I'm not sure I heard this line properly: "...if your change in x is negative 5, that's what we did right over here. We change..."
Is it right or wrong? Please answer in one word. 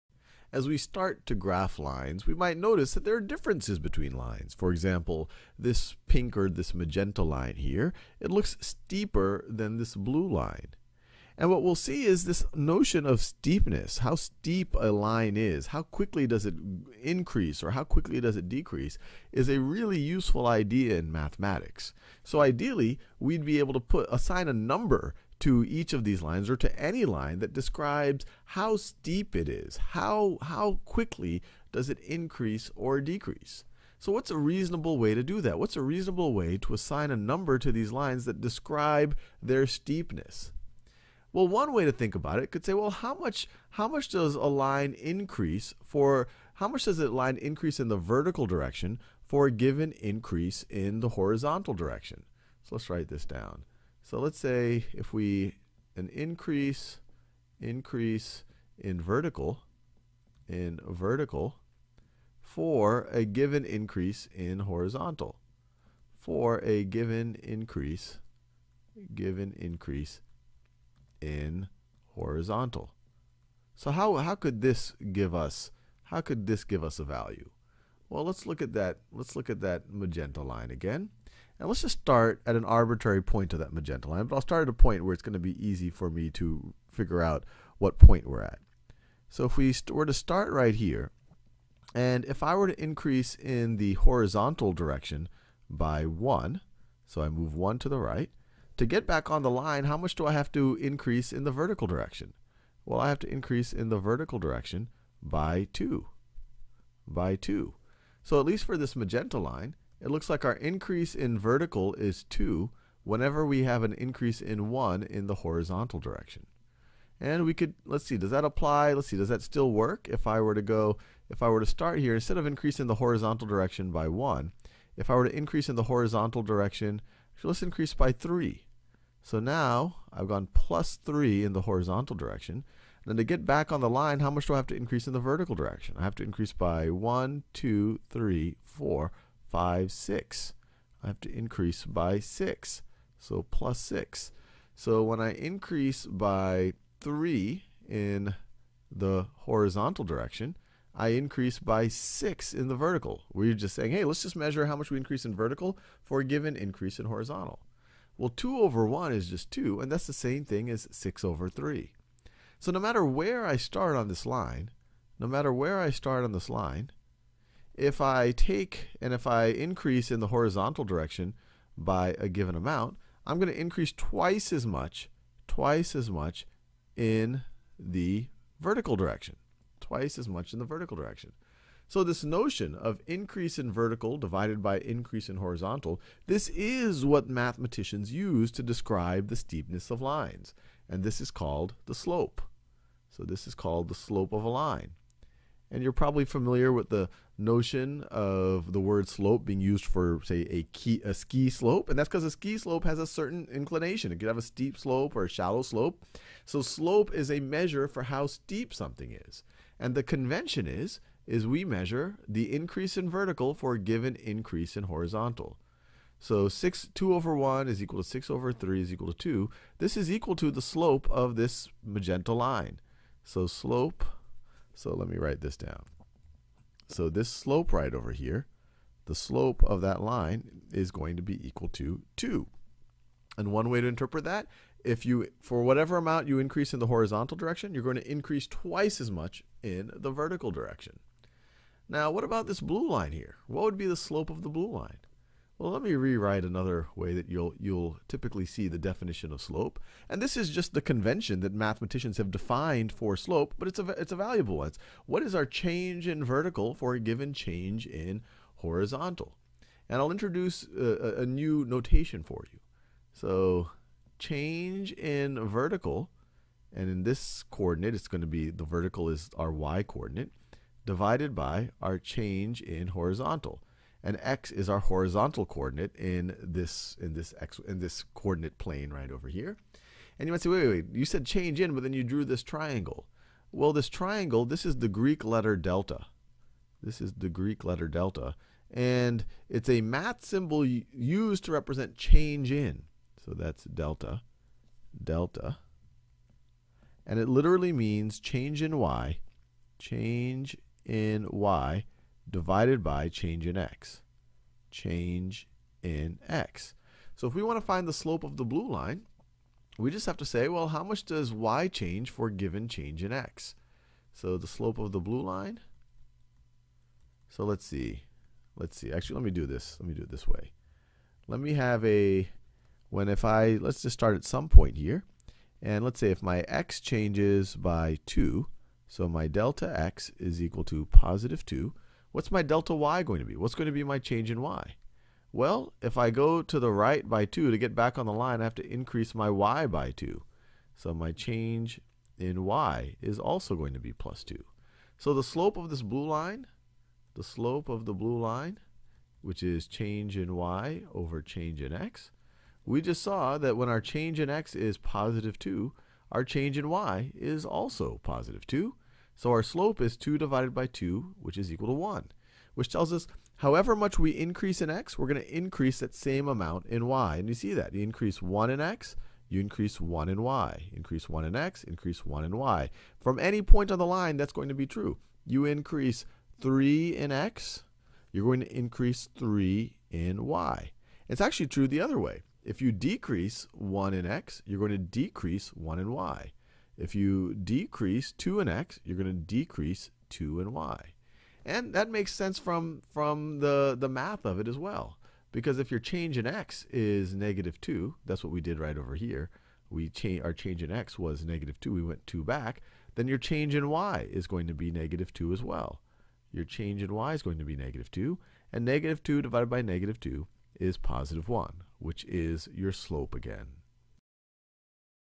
wrong.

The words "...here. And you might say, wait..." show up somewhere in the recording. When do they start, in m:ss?
4:39.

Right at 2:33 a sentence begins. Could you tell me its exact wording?
We're just saying, hey, let's just measure how much we increase in vertical for a given increase in horizontal.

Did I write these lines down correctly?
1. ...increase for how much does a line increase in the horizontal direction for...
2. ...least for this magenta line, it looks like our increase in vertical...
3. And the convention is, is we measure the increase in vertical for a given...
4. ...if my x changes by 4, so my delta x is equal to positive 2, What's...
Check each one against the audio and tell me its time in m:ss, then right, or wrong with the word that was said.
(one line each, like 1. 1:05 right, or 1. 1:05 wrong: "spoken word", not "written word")
1. 0:44 wrong: "vertical", not "horizontal"
2. 1:48 right
3. 3:29 right
4. 5:26 wrong: "2", not "4".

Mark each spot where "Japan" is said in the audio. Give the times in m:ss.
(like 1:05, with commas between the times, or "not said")
not said.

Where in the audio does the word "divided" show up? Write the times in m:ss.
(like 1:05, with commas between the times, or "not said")
3:04, 4:30, 5:02, 6:00, 6:49.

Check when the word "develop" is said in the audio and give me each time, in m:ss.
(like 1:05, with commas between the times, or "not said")
not said.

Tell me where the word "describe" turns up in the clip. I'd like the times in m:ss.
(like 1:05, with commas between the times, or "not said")
0:27, 0:38, 3:08.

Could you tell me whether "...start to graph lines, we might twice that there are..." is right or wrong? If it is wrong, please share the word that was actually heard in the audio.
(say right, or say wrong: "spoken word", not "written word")
wrong: "notice", not "twice".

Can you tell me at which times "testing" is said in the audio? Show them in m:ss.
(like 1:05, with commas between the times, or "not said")
not said.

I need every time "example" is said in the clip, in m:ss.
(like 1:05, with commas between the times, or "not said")
0:04.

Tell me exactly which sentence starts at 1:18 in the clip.
Well, let's look at that, let's look at that magenta line again.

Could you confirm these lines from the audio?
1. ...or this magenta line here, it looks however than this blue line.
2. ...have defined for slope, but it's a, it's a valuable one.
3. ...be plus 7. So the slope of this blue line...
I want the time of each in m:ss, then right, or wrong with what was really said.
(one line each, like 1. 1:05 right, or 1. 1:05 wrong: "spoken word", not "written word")
1. 0:06 wrong: "steeper", not "however"
2. 4:12 right
3. 5:43 wrong: "2", not "7".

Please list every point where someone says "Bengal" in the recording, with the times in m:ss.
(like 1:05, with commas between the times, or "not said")
not said.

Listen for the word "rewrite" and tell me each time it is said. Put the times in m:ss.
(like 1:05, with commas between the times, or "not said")
4:05.